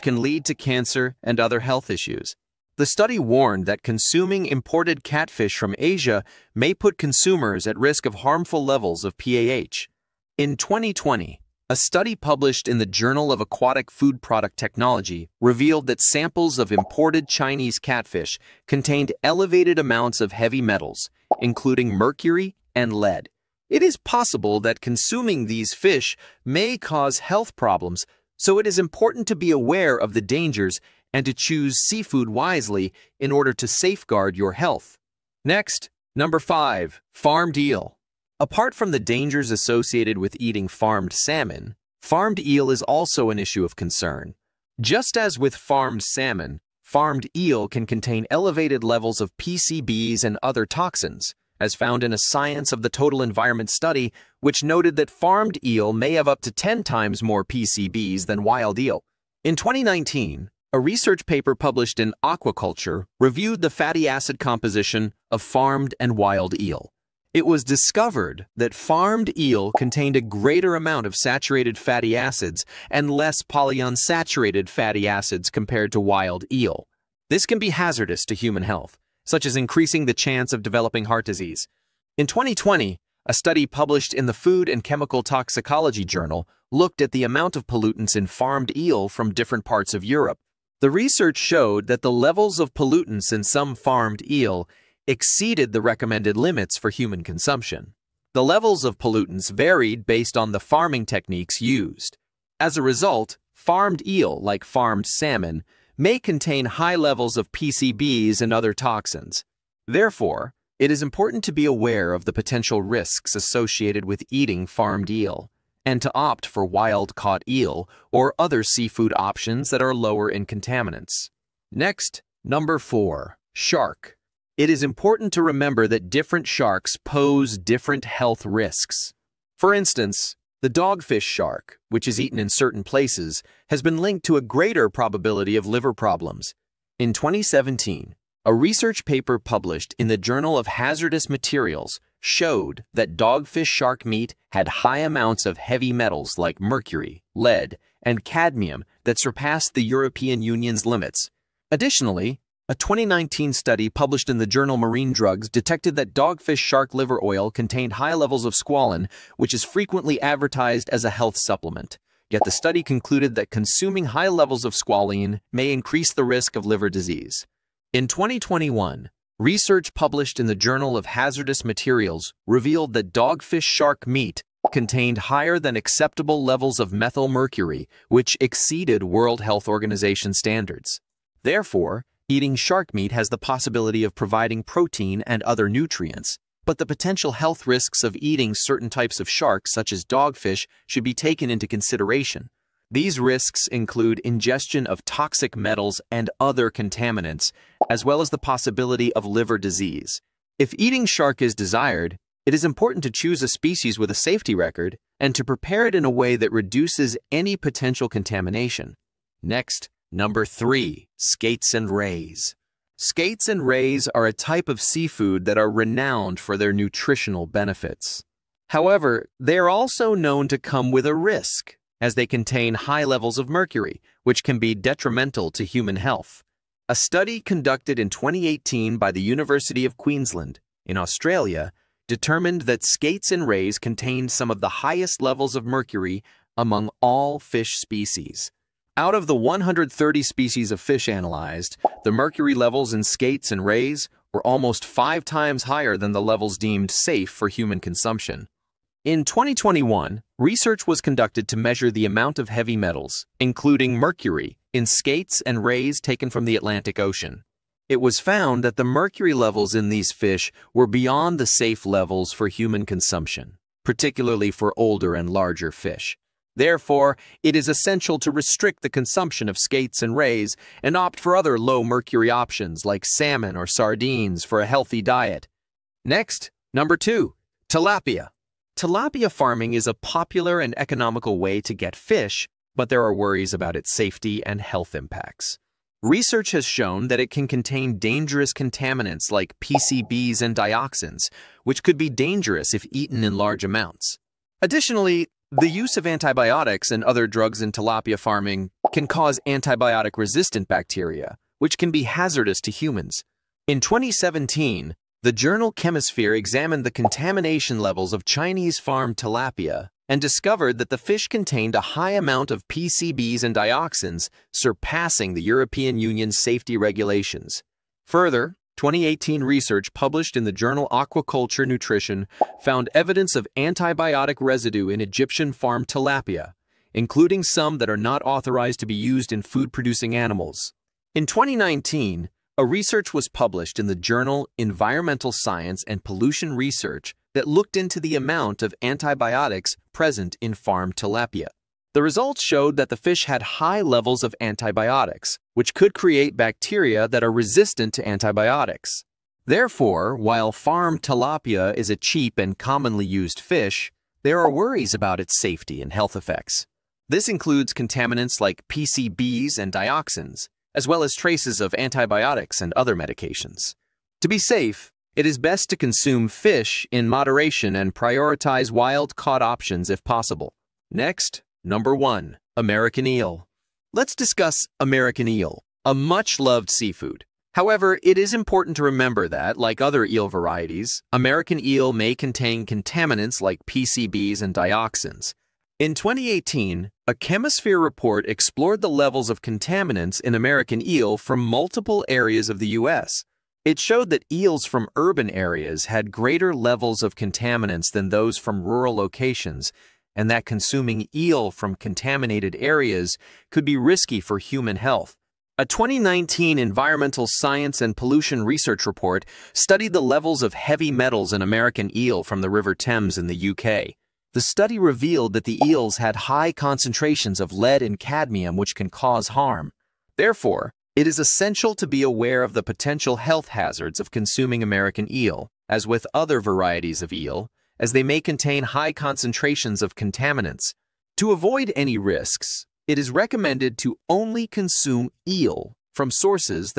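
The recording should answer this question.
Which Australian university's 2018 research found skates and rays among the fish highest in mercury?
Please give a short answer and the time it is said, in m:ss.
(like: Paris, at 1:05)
University of Queensland, at 3:49.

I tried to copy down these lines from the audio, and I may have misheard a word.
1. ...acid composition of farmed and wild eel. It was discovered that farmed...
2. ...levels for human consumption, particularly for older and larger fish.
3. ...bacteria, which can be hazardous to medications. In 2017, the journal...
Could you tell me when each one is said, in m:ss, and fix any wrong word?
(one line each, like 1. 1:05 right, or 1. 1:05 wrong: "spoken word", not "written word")
1. 1:04 right
2. 4:21 right
3. 5:00 wrong: "humans", not "medications".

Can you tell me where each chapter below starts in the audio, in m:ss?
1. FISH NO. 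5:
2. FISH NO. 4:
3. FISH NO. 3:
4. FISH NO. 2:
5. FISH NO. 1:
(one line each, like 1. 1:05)
1. 0:34
2. 2:00
3. 3:30
4. 4:34
5. 5:59.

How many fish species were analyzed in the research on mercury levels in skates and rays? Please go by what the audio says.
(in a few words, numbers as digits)
130.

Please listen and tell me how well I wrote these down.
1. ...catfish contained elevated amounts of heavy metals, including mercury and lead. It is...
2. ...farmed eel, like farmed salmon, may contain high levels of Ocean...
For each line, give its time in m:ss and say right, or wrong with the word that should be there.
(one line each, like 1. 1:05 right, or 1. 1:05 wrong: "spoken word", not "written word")
1. 0:17 right
2. 1:43 wrong: "PCBs", not "Ocean".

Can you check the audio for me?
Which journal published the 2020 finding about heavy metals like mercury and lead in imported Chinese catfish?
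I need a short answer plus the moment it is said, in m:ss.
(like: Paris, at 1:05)
Journal of Aquatic Food Product Technology, at 0:12.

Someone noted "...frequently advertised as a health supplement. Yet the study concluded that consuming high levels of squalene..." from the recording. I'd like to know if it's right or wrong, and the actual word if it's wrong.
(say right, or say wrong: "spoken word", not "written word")
right.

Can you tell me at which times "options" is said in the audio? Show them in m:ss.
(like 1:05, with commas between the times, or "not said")
1:59, 4:32, 6:09.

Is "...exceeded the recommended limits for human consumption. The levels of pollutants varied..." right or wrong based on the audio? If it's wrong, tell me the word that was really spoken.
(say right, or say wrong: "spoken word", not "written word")
right.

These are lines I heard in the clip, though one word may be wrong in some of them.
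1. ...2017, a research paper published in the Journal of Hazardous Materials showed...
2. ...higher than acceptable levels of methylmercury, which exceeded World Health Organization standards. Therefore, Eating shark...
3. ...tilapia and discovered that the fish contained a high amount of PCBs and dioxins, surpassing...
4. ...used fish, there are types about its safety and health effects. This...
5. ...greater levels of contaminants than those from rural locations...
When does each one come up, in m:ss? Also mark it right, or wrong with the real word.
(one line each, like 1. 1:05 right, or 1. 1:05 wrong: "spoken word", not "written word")
1. 2:17 right
2. 2:55 right
3. 5:09 right
4. 5:53 wrong: "worries", not "types"
5. 6:36 right.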